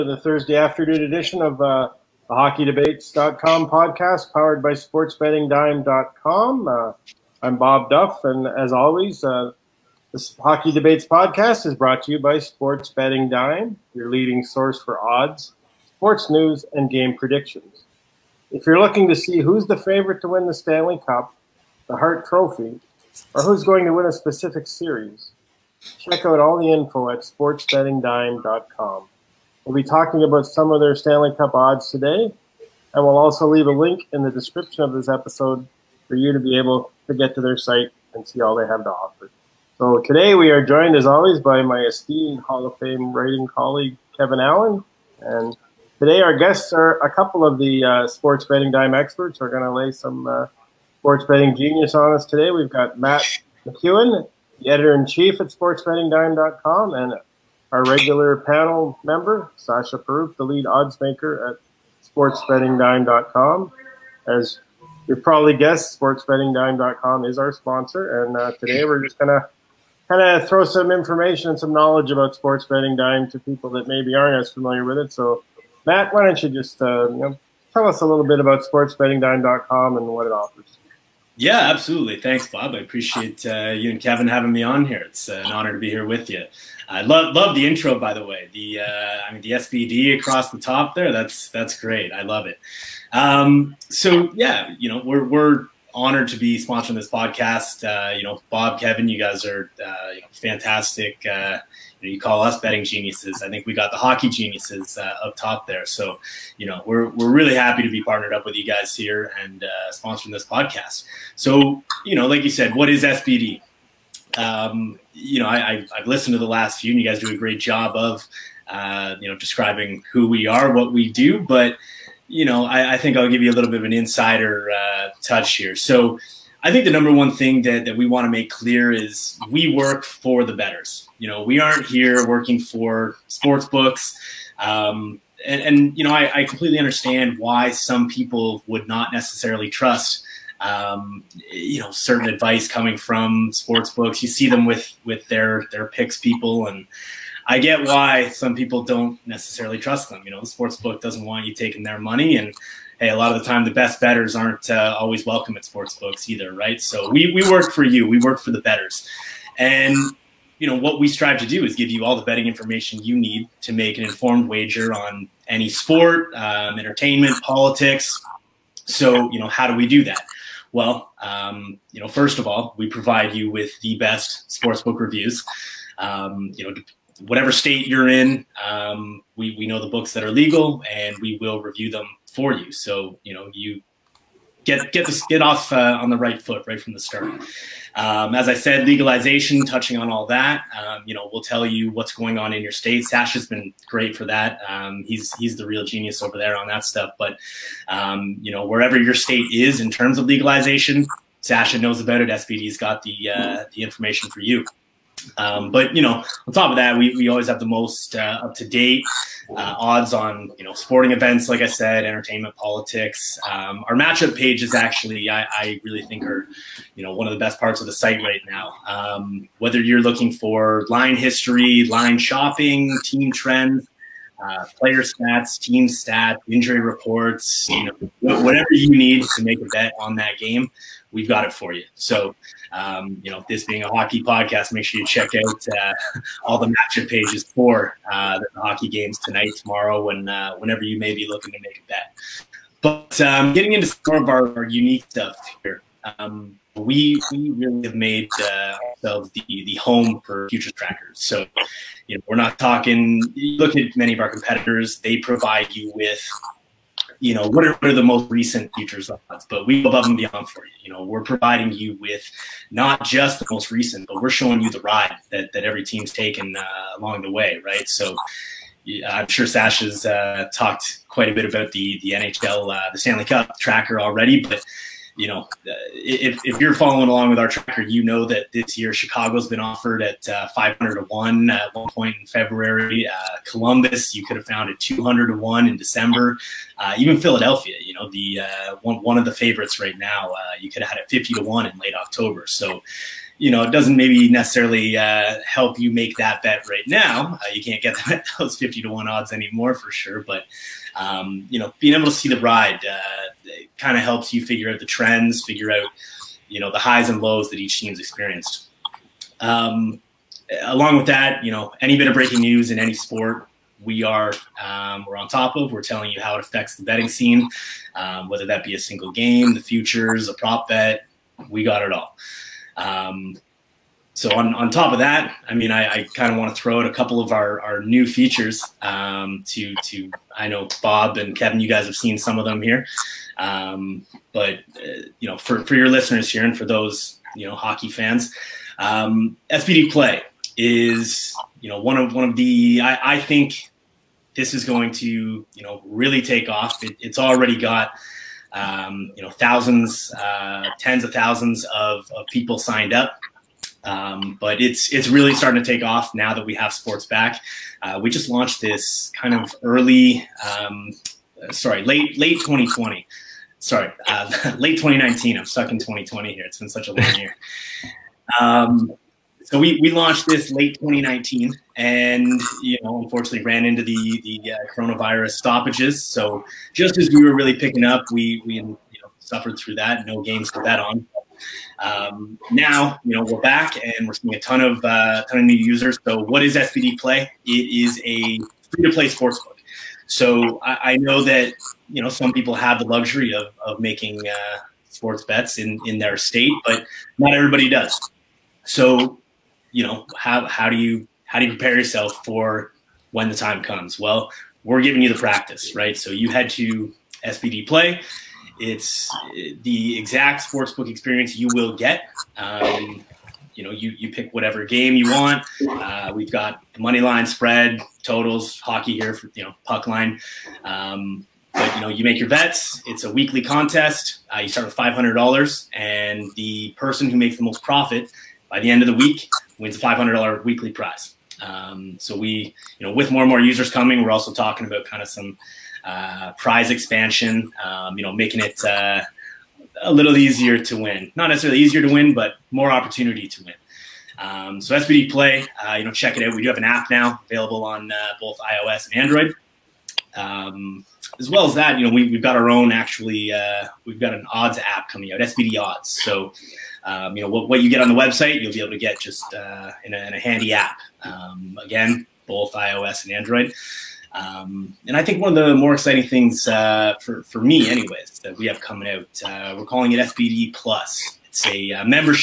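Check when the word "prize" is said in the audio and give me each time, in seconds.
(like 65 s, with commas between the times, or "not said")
430 s, 436 s.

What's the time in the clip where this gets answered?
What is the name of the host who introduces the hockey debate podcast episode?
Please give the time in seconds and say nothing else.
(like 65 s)
7 s.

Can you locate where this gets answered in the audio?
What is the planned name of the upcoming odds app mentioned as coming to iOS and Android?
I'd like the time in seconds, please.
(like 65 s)
455 s.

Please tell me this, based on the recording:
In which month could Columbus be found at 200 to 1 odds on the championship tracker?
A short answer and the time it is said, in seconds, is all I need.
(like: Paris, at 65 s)
December, at 285 s.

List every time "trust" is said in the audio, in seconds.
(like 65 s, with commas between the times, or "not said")
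139 s, 149 s.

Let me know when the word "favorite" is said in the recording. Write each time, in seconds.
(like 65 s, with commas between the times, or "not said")
19 s, 289 s.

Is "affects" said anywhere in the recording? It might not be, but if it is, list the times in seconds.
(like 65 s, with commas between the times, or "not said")
316 s.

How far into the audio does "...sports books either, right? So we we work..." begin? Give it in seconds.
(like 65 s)
155 s.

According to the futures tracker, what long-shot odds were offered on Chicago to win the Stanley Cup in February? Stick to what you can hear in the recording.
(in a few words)
500 to 1.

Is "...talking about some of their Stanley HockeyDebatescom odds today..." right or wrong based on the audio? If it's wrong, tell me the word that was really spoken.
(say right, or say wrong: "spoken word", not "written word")
wrong: "Cup", not "HockeyDebatescom".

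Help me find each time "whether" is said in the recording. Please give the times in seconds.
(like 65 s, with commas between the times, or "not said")
219 s, 318 s.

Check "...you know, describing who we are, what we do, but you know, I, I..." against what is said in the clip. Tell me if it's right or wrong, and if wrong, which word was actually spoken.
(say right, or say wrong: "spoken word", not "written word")
right.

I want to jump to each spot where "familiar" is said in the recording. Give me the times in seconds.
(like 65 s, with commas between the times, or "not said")
74 s.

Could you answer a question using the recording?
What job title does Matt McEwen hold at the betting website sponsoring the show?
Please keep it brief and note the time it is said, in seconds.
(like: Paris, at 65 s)
editor in chief, at 54 s.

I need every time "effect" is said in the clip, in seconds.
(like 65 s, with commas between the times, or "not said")
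not said.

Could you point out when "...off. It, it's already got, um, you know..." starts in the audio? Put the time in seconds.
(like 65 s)
346 s.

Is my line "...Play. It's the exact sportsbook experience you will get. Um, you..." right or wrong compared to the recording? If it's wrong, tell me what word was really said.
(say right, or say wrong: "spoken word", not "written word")
right.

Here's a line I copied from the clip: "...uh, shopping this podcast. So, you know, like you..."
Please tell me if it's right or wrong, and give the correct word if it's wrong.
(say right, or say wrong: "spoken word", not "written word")
wrong: "sponsoring", not "shopping".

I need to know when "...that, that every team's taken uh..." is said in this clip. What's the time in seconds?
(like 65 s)
265 s.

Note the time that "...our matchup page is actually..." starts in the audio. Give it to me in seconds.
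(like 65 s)
213 s.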